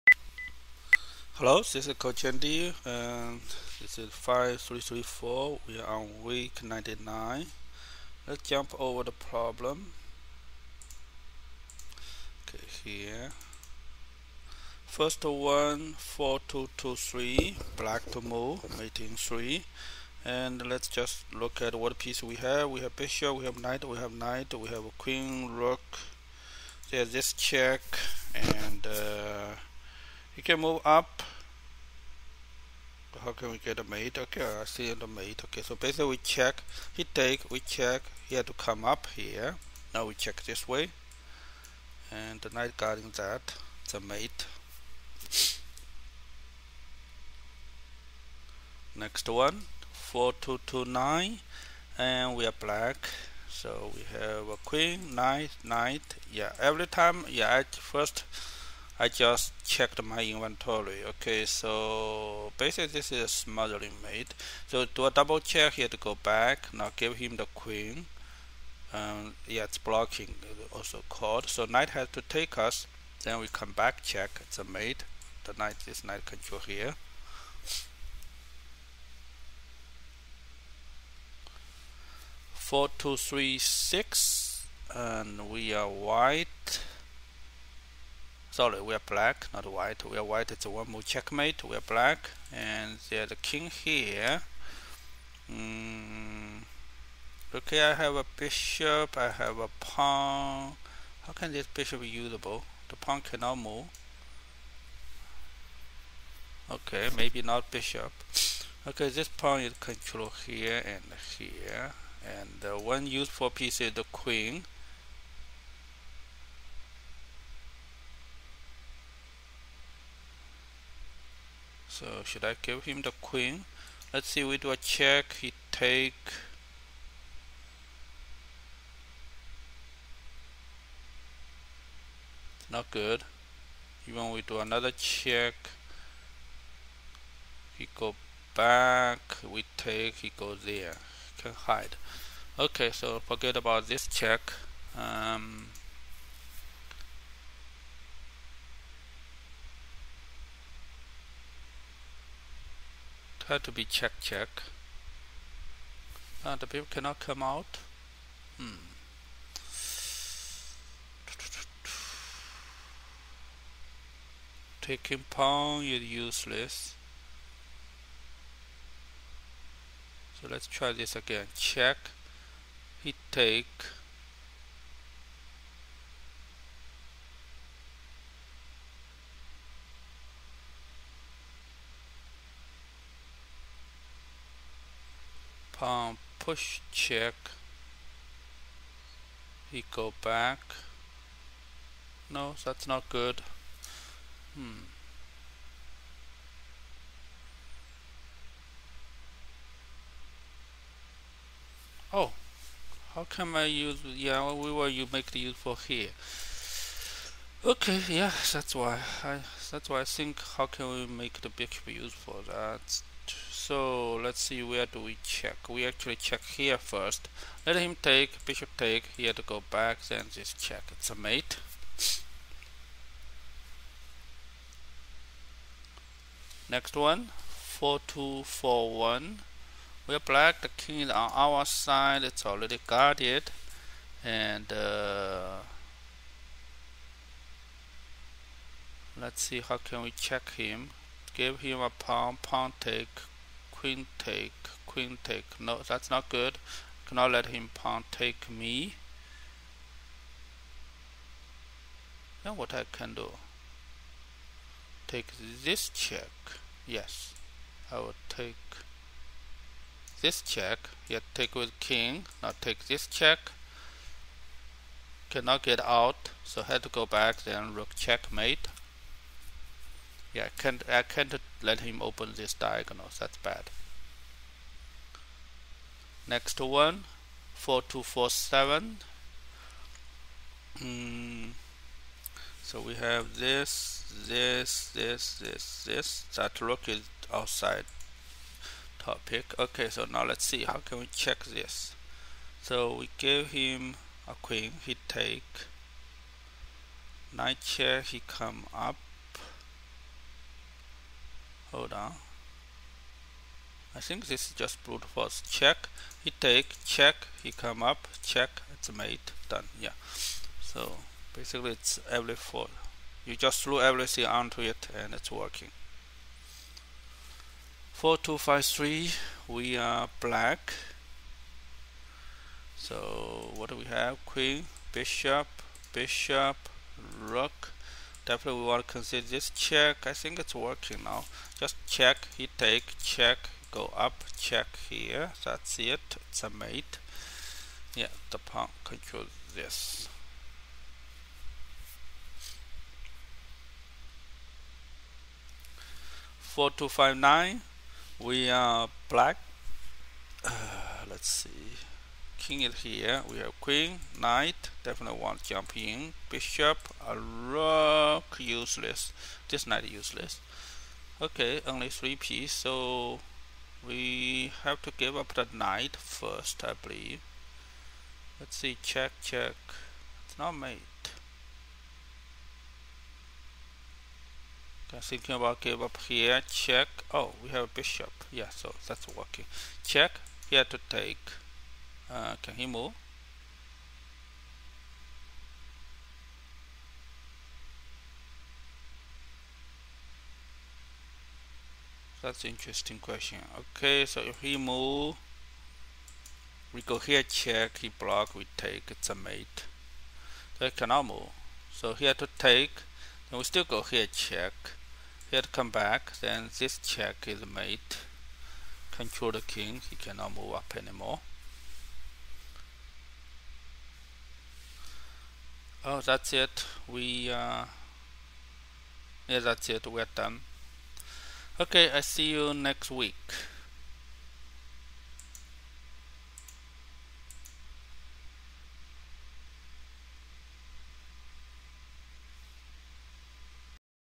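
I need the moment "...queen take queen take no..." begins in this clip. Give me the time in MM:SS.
04:03.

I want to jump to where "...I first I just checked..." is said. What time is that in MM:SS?
00:57.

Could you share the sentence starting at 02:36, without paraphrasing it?
and ah, the people cannot come out.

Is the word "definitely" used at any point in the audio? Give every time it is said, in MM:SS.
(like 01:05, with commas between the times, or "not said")
05:28, 05:54.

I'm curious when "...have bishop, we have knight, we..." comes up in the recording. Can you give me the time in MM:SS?
00:22.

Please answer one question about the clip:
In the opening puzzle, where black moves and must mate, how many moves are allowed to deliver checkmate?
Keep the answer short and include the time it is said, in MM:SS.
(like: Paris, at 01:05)
3, at 00:18.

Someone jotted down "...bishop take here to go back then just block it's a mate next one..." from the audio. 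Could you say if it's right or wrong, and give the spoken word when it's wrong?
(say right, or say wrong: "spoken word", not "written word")
wrong: "check", not "block".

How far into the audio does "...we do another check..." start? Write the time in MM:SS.
02:14.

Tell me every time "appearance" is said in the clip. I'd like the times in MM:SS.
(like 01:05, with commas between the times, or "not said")
not said.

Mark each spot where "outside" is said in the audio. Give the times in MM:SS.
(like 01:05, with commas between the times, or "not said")
04:47.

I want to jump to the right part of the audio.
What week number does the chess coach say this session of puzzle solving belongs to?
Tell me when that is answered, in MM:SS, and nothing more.
00:06.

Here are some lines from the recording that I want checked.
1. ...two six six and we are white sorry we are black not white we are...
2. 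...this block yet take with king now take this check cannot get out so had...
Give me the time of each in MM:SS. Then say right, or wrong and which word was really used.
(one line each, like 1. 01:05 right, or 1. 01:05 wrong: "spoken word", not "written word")
1. 01:22 wrong: "three", not "six"
2. 04:20 wrong: "check", not "block".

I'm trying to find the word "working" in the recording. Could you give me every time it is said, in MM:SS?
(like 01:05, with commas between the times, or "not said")
05:15, 05:30, 06:19.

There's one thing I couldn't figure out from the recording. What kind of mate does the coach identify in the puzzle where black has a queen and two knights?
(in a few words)
smothering mate.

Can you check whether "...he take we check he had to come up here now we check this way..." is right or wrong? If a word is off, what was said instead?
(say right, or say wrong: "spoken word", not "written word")
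right.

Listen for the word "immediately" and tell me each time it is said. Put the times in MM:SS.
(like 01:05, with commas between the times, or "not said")
not said.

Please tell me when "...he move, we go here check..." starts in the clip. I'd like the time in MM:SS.
06:34.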